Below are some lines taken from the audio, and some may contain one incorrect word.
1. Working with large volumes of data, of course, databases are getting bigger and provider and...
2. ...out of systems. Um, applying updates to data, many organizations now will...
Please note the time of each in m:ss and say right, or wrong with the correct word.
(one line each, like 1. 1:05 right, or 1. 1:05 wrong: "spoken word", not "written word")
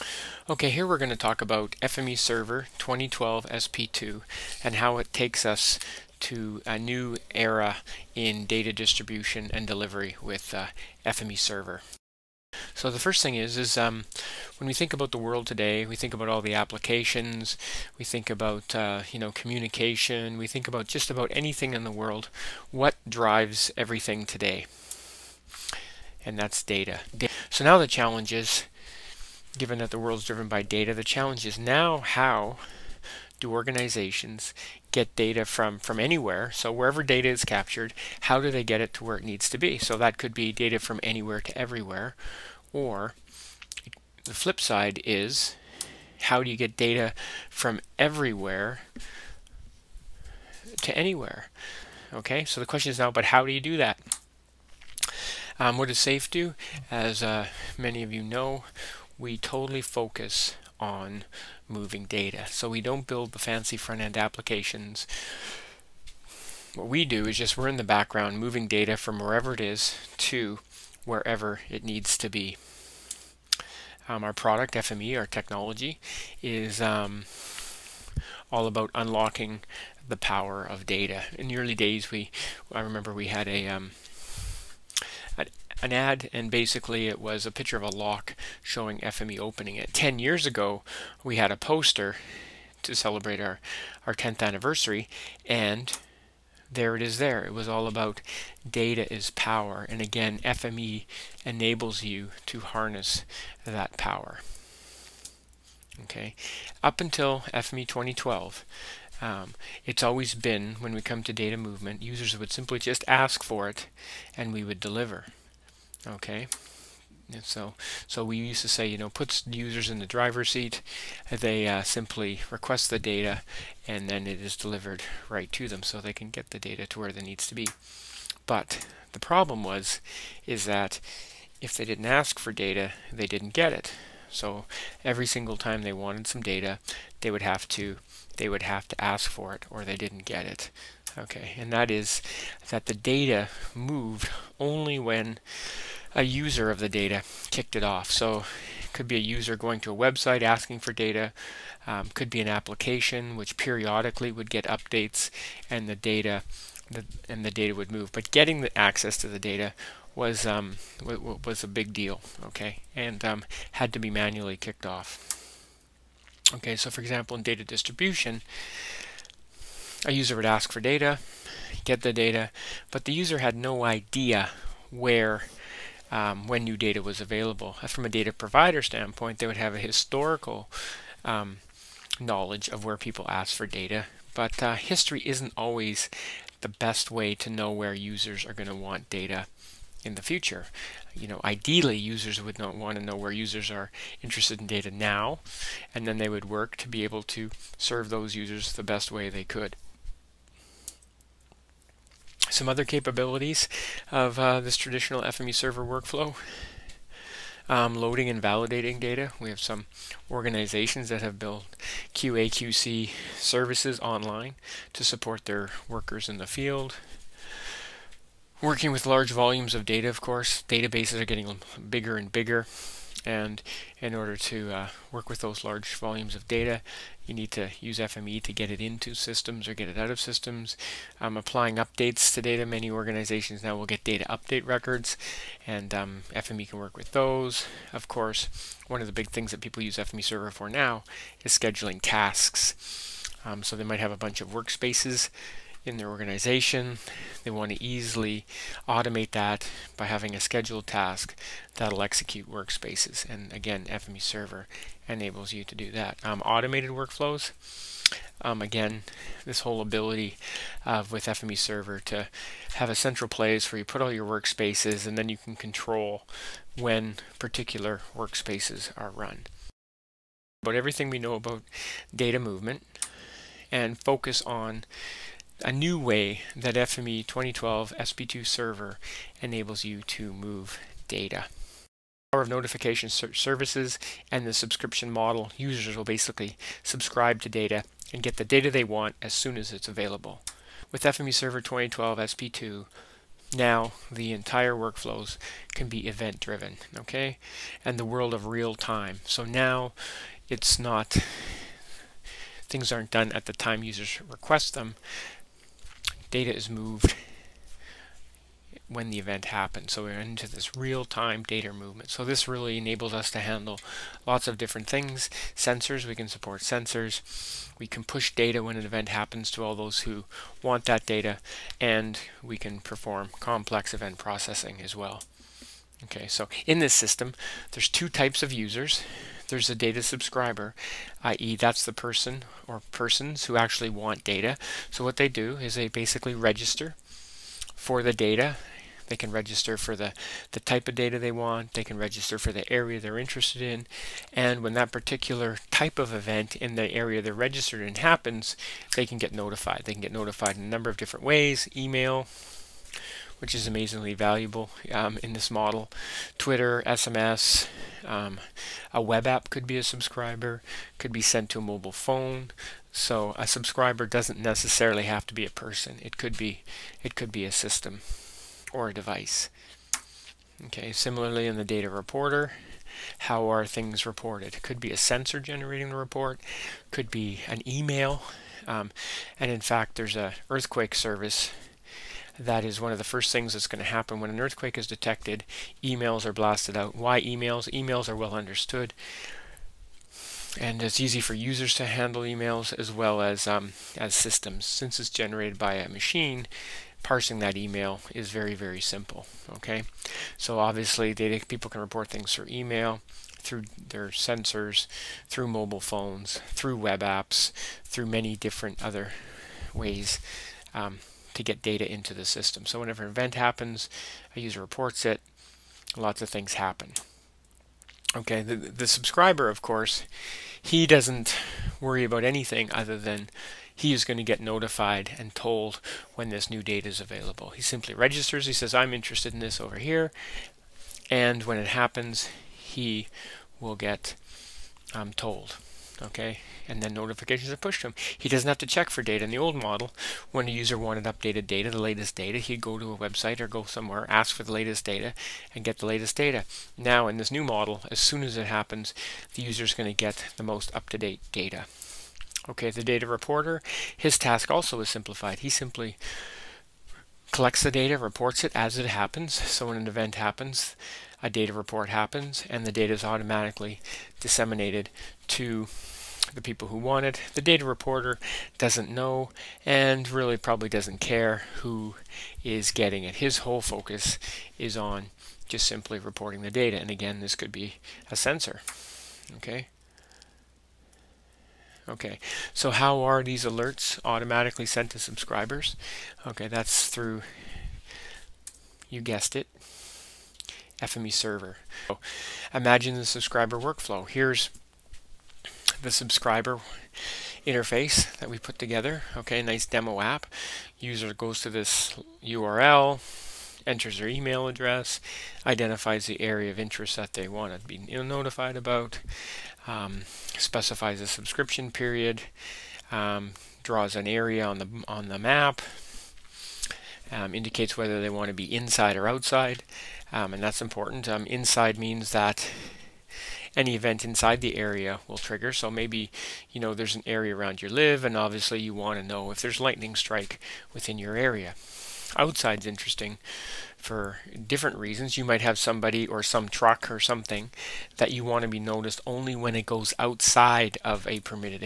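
1. 3:38 wrong: "bigger", not "provider"
2. 3:49 right.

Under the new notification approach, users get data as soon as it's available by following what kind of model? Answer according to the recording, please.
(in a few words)
Subscription model.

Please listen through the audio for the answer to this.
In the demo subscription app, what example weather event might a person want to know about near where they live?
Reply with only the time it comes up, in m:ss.
8:49.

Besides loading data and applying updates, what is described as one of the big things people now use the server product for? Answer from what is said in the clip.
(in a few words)
Scheduling tasks.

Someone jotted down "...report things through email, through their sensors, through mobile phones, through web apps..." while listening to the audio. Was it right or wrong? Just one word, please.
right.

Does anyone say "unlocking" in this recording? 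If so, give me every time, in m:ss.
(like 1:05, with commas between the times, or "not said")
1:18.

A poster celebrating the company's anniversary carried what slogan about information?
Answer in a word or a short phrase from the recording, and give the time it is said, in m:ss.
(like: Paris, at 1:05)
Data is power, at 1:38.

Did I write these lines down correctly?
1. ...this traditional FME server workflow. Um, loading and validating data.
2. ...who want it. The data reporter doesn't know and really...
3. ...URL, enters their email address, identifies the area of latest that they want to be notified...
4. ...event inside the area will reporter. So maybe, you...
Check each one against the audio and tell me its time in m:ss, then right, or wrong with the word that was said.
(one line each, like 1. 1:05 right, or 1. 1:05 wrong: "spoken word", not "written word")
1. 3:24 right
2. 7:46 right
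3. 8:22 wrong: "interest", not "latest"
4. 8:43 wrong: "trigger", not "reporter".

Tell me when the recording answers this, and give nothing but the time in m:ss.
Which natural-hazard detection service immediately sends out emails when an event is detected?
6:20.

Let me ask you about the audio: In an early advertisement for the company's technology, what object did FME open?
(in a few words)
A lock.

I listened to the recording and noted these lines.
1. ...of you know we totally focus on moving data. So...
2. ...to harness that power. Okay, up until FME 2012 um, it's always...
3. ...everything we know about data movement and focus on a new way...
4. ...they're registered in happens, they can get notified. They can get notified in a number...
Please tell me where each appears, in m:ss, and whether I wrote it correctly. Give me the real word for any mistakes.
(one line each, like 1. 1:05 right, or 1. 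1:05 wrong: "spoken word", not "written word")
1. 0:58 right
2. 1:42 right
3. 4:30 right
4. 5:47 right.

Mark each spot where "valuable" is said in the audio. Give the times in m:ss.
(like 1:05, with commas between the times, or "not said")
5:54.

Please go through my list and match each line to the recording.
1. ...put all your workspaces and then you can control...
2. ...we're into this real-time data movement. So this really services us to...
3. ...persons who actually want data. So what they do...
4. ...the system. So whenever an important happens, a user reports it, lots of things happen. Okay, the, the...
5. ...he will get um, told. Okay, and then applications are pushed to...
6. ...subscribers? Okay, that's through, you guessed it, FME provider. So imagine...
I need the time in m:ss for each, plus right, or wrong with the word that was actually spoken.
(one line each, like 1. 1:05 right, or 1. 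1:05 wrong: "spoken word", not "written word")
1. 4:23 right
2. 5:10 wrong: "enables", not "services"
3. 5:32 right
4. 6:52 wrong: "event", not "important"
5. 7:12 wrong: "notifications", not "applications"
6. 8:05 wrong: "server", not "provider".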